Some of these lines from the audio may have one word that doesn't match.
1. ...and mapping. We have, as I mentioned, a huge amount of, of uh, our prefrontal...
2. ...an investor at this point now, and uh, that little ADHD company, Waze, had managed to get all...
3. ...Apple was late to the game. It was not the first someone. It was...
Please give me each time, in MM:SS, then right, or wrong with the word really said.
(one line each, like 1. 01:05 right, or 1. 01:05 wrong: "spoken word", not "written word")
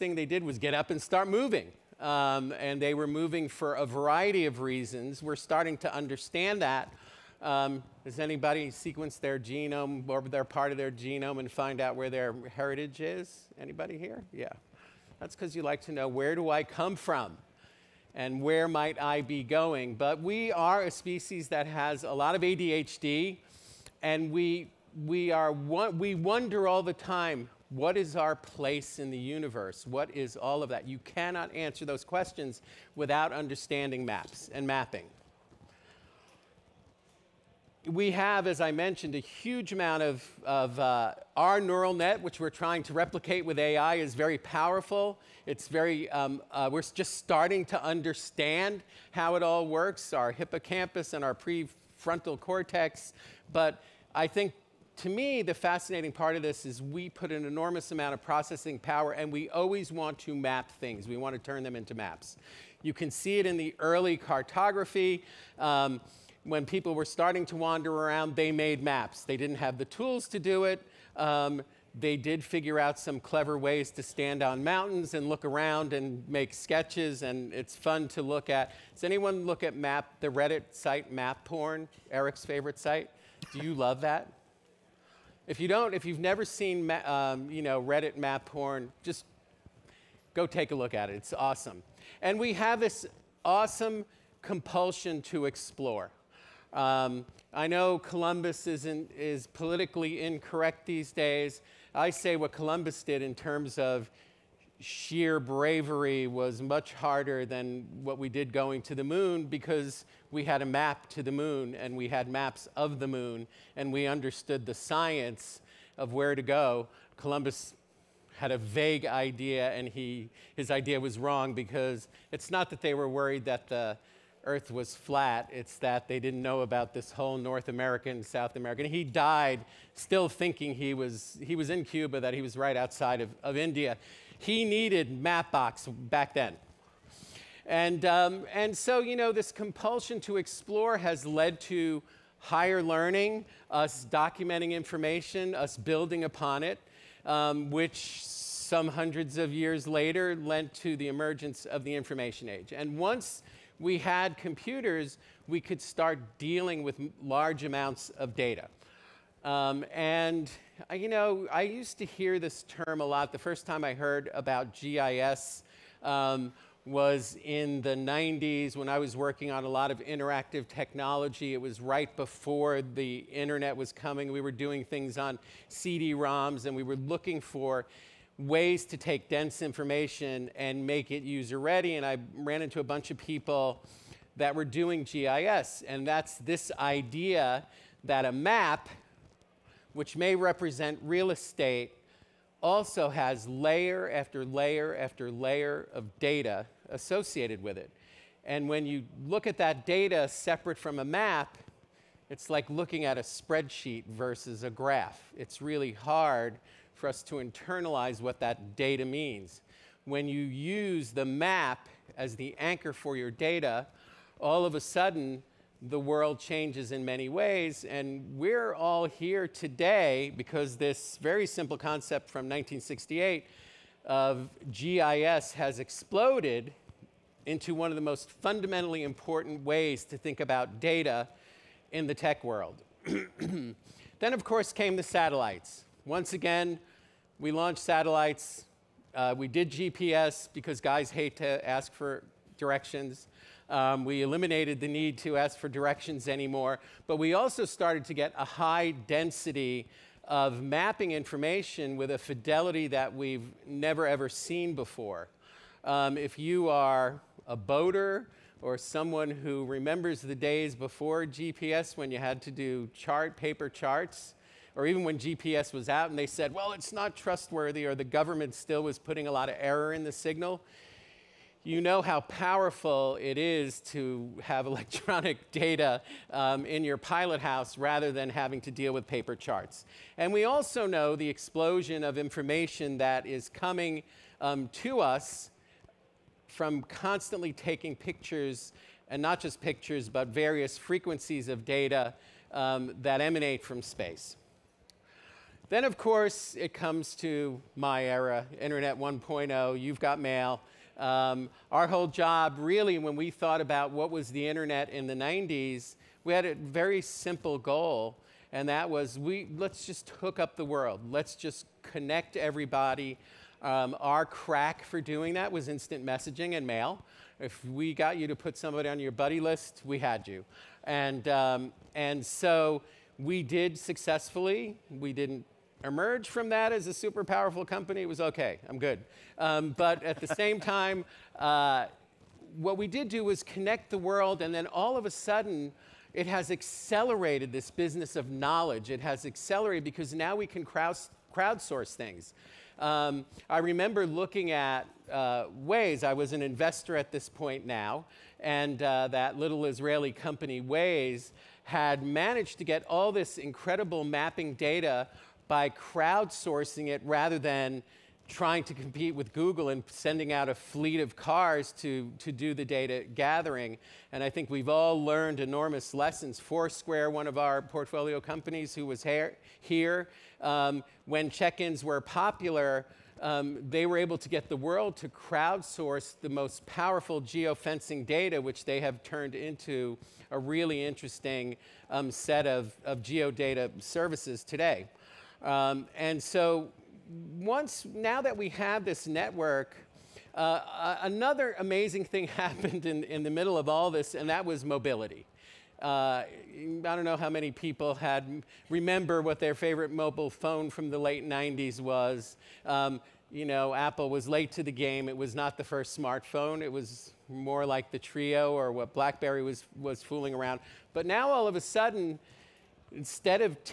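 1. 00:34 wrong: "neural", not "prefrontal"
2. 05:46 wrong: "Israeli", not "ADHD"
3. 06:43 wrong: "smartphone", not "someone".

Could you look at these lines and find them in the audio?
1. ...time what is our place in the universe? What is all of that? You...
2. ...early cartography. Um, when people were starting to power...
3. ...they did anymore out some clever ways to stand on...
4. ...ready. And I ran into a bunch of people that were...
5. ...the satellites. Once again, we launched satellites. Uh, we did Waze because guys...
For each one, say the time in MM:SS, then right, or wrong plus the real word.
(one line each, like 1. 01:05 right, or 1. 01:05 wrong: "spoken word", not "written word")
1. 00:26 right
2. 01:03 wrong: "wander", not "power"
3. 01:11 wrong: "figure", not "anymore"
4. 03:01 right
5. 03:54 wrong: "GPS", not "Waze".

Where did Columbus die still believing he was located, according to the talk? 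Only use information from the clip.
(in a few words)
Cuba.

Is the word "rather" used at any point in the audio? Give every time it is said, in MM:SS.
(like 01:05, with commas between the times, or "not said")
04:37, 05:57.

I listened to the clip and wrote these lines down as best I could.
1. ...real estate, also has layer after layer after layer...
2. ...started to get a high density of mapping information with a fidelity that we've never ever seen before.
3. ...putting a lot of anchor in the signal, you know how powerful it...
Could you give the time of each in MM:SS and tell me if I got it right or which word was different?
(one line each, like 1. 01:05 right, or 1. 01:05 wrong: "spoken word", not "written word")
1. 03:11 right
2. 04:07 right
3. 04:28 wrong: "error", not "anchor".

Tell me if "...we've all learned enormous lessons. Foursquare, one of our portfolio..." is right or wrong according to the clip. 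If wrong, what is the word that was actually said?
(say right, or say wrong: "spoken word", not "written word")
right.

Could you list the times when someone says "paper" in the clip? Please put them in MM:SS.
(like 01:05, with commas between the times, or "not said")
04:23, 04:39.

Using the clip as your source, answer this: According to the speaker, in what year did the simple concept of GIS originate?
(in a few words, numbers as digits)
1968.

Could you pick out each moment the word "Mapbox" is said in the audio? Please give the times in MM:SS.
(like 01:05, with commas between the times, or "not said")
02:15.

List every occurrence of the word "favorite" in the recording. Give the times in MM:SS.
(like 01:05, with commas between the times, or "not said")
01:22, 06:39.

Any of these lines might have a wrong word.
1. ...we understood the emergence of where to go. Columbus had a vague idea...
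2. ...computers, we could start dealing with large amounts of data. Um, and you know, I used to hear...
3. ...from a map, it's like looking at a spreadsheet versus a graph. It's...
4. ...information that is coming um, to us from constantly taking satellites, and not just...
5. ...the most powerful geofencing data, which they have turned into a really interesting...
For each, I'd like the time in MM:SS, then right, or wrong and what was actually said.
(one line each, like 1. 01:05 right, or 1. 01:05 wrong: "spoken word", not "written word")
1. 01:53 wrong: "science", not "emergence"
2. 02:34 right
3. 03:20 right
4. 04:42 wrong: "pictures", not "satellites"
5. 06:16 right.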